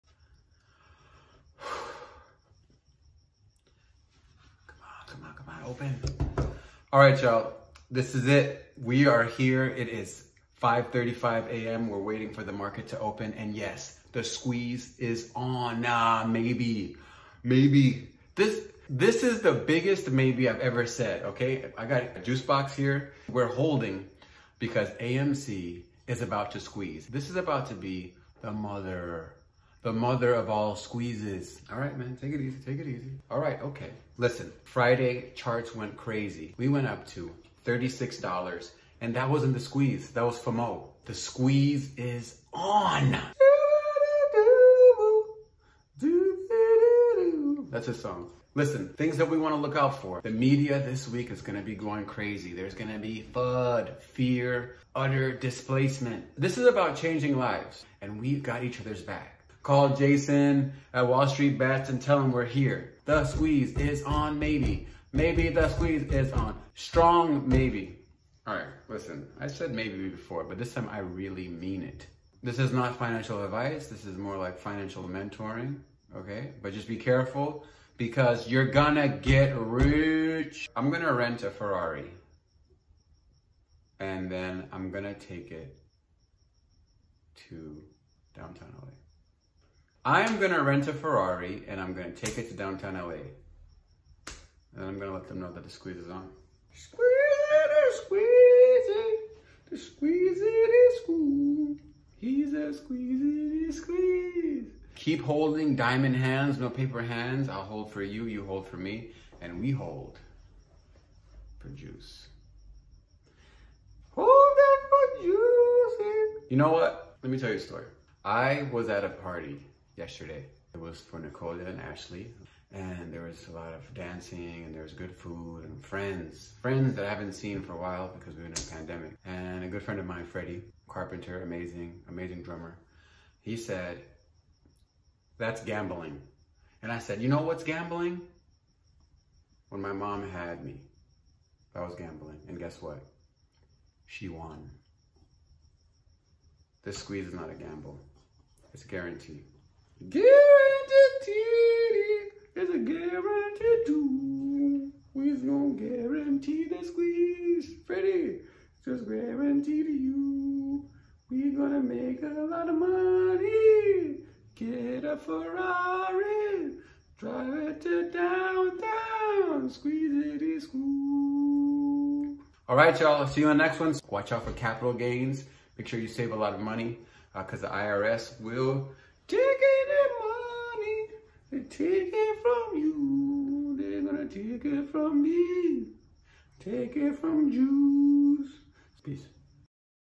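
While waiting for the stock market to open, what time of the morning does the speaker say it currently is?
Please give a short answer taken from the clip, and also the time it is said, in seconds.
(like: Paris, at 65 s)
5:35 a.m., at 10 s.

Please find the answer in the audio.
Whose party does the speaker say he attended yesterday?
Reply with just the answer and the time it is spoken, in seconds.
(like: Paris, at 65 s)
Nicola and Ashley, at 121 s.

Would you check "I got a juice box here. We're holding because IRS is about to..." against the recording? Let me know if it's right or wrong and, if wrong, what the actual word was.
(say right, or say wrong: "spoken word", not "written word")
wrong: "AMC", not "IRS".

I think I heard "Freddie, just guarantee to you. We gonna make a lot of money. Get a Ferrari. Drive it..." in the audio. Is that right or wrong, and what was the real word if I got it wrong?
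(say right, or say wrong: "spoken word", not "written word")
right.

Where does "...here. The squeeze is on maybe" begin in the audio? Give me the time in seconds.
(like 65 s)
62 s.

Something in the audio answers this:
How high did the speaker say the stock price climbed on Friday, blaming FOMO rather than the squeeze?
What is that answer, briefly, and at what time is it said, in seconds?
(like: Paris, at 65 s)
$36, at 37 s.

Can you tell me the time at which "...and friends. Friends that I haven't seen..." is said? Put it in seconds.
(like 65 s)
125 s.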